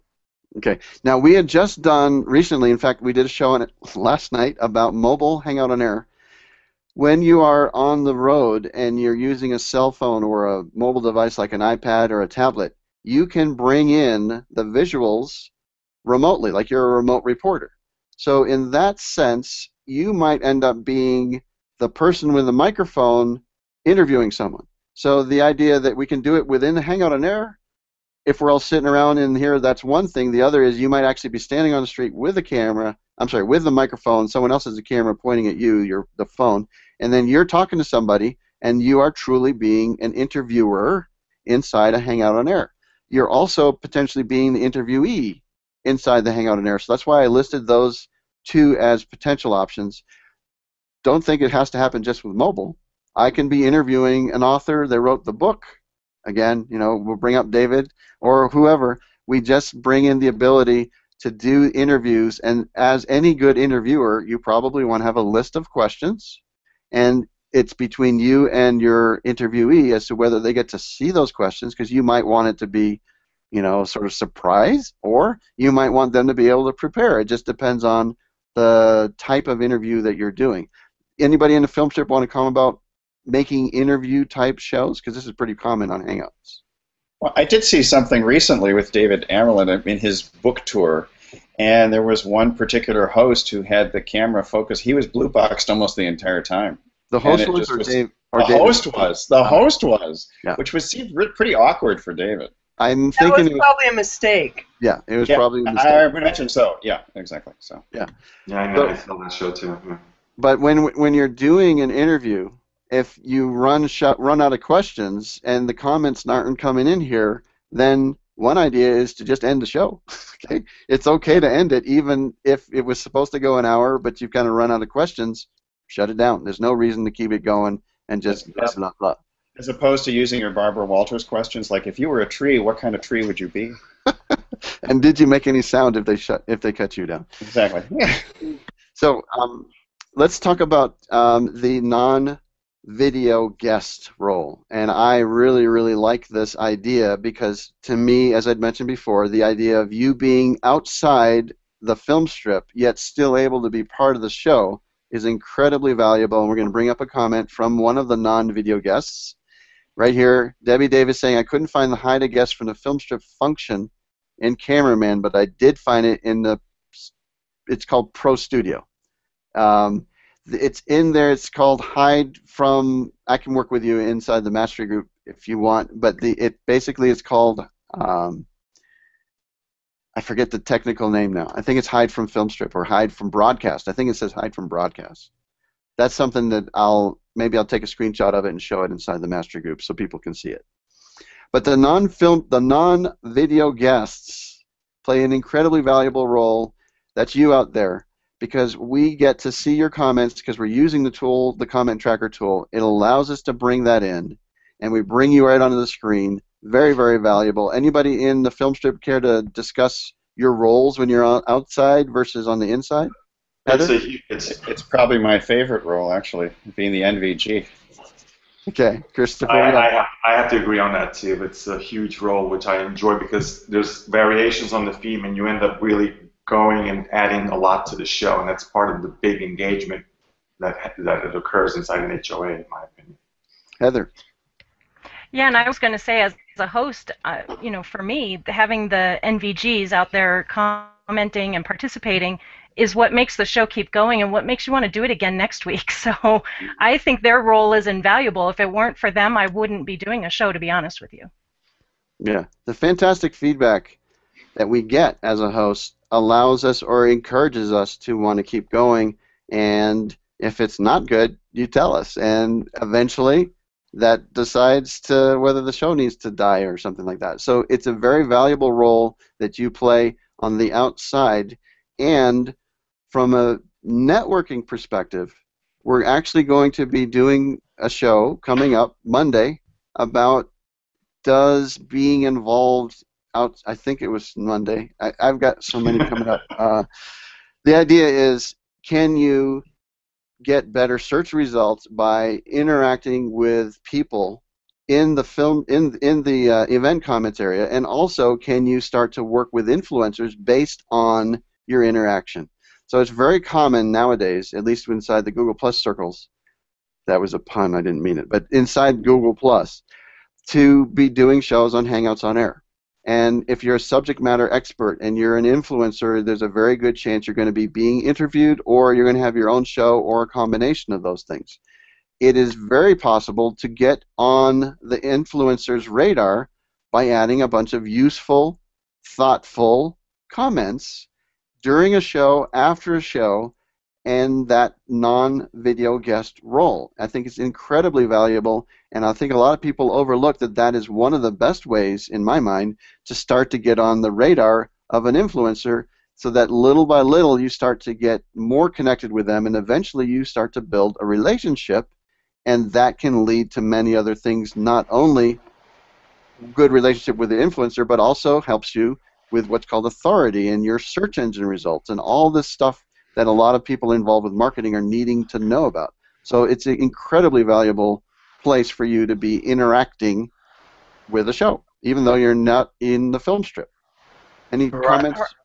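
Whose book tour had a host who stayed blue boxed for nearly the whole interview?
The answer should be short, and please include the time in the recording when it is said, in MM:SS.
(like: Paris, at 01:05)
David Amerland, at 01:28.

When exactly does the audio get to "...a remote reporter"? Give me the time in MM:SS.
00:16.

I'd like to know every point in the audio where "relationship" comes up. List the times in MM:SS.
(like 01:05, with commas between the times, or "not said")
05:51, 05:56.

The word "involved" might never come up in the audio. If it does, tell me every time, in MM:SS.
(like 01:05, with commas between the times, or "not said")
04:42, 06:03.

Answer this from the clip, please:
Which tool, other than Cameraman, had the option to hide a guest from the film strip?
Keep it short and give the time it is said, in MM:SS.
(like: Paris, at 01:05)
Pro Studio, at 02:48.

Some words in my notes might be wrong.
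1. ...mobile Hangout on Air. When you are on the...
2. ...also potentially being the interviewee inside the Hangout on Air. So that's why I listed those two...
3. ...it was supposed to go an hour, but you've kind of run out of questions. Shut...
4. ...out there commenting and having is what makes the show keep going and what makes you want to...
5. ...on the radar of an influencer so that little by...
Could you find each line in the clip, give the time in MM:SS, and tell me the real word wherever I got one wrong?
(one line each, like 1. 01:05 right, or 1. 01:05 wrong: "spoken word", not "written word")
1. 00:04 right
2. 00:43 right
3. 02:02 right
4. 03:59 wrong: "participating", not "having"
5. 05:43 right.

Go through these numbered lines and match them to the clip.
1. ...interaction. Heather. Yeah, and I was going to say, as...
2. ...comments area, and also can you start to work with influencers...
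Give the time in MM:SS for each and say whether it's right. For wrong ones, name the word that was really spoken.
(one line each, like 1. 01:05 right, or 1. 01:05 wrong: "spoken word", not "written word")
1. 03:52 wrong: "opinion", not "interaction"
2. 04:57 right.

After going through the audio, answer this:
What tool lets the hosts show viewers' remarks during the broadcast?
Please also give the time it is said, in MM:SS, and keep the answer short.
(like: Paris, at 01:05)
comment tracker, at 03:21.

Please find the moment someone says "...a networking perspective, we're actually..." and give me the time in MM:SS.
04:33.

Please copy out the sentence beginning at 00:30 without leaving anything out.
The other is you might actually be standing on the street with a camera.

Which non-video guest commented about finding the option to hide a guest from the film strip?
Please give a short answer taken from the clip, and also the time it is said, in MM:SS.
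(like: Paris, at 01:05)
Debbie Davis, at 02:40.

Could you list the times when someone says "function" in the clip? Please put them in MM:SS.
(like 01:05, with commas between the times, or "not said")
02:43.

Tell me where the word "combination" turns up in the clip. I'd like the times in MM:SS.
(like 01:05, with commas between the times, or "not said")
05:20.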